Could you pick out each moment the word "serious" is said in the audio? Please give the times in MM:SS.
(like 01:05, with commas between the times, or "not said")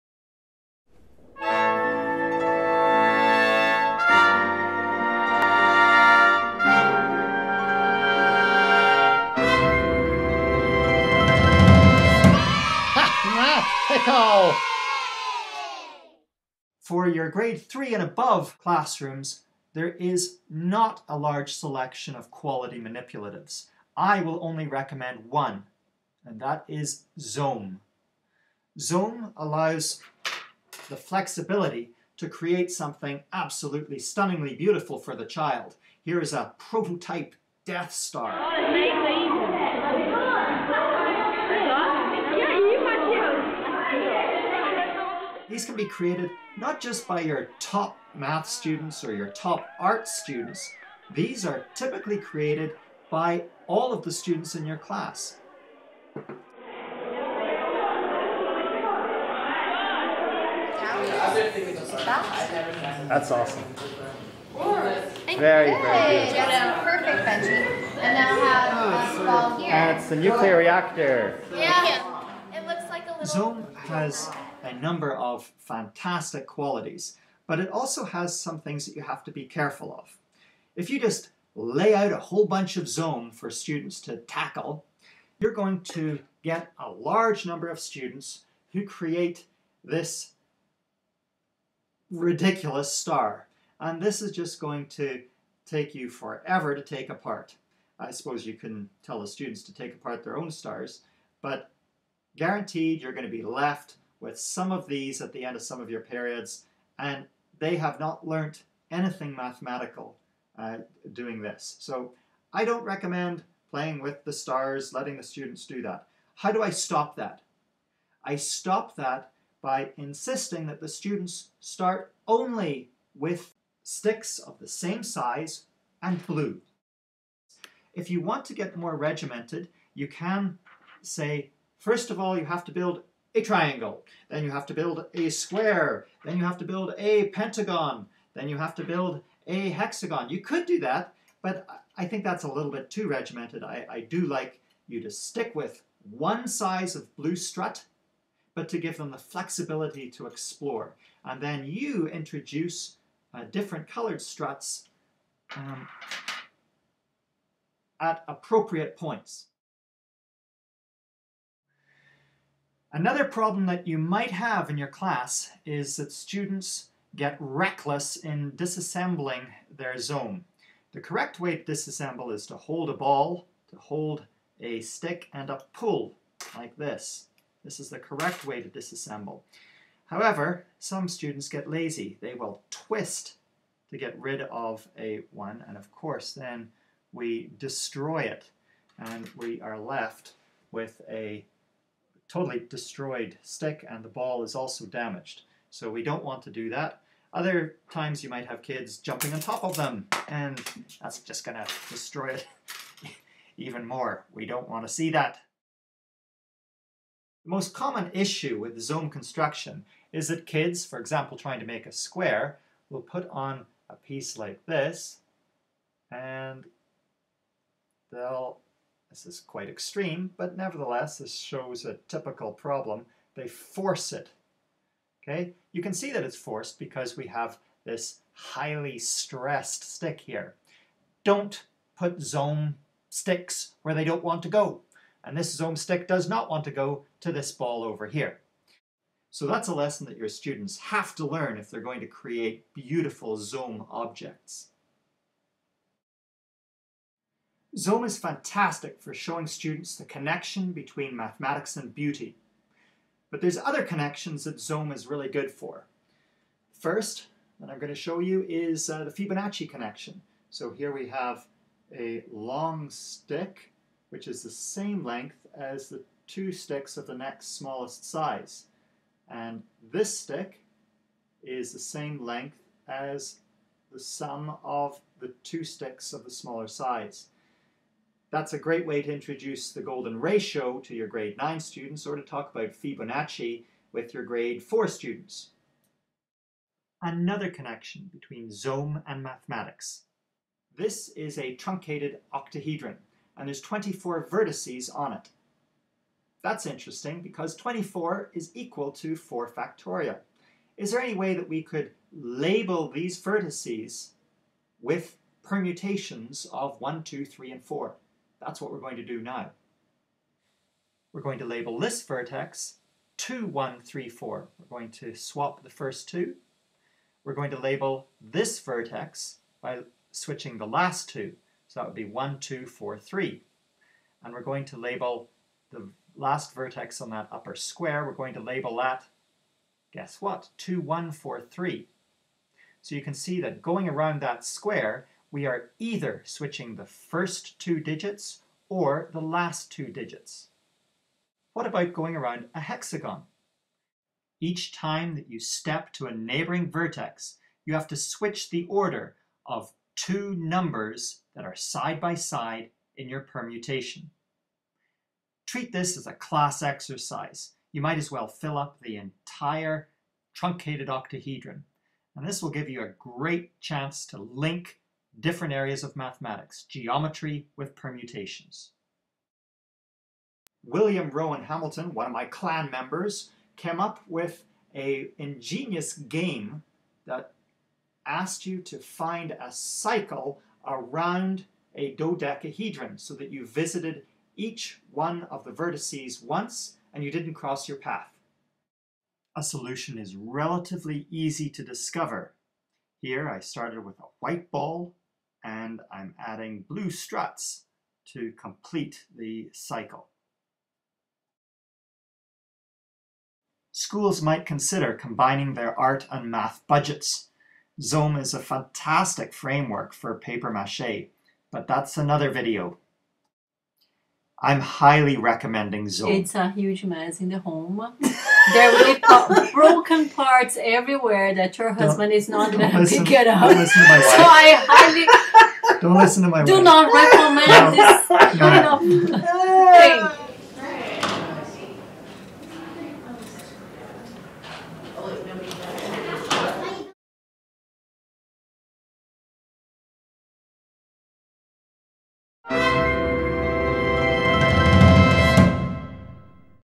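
not said.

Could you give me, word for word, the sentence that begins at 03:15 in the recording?
So we don't want to do that.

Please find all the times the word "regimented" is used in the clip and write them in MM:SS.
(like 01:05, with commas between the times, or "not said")
02:08, 02:23.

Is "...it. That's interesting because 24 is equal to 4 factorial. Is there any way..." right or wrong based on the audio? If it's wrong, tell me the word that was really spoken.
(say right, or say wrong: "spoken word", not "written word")
right.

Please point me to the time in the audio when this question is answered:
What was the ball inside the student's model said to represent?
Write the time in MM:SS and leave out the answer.
01:10.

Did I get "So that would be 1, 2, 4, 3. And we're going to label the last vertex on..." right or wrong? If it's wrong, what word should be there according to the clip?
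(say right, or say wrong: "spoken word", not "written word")
right.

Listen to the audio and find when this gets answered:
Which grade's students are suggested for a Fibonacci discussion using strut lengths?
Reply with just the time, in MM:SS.
04:44.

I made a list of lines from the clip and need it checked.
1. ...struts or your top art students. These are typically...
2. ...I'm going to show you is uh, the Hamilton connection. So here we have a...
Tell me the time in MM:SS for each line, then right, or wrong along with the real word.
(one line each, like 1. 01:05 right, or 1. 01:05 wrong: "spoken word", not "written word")
1. 00:48 wrong: "students", not "struts"
2. 04:17 wrong: "Fibonacci", not "Hamilton".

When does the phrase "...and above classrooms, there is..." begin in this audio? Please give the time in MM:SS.
00:17.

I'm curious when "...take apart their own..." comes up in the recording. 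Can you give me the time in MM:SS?
01:39.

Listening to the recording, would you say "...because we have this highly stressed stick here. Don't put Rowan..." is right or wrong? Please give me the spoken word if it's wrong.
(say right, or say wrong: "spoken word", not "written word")
wrong: "Zome", not "Rowan".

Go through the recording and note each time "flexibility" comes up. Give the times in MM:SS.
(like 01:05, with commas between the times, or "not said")
00:30, 02:29.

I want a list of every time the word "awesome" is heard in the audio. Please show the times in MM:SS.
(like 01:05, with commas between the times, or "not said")
01:03.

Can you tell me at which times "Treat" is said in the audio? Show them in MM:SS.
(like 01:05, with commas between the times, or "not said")
05:55.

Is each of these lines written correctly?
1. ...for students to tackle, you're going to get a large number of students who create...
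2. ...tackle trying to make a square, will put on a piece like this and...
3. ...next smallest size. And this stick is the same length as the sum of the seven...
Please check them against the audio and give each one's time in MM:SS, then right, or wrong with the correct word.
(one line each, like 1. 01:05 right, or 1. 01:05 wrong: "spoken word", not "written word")
1. 01:23 right
2. 03:30 wrong: "example", not "tackle"
3. 04:27 wrong: "two", not "seven".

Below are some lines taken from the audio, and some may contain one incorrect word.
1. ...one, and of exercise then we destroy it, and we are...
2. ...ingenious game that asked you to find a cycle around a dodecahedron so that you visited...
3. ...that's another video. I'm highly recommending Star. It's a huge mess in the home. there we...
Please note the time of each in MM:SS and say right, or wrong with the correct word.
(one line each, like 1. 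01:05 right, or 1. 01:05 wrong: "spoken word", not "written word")
1. 03:05 wrong: "course", not "exercise"
2. 06:15 right
3. 06:51 wrong: "Zome", not "Star".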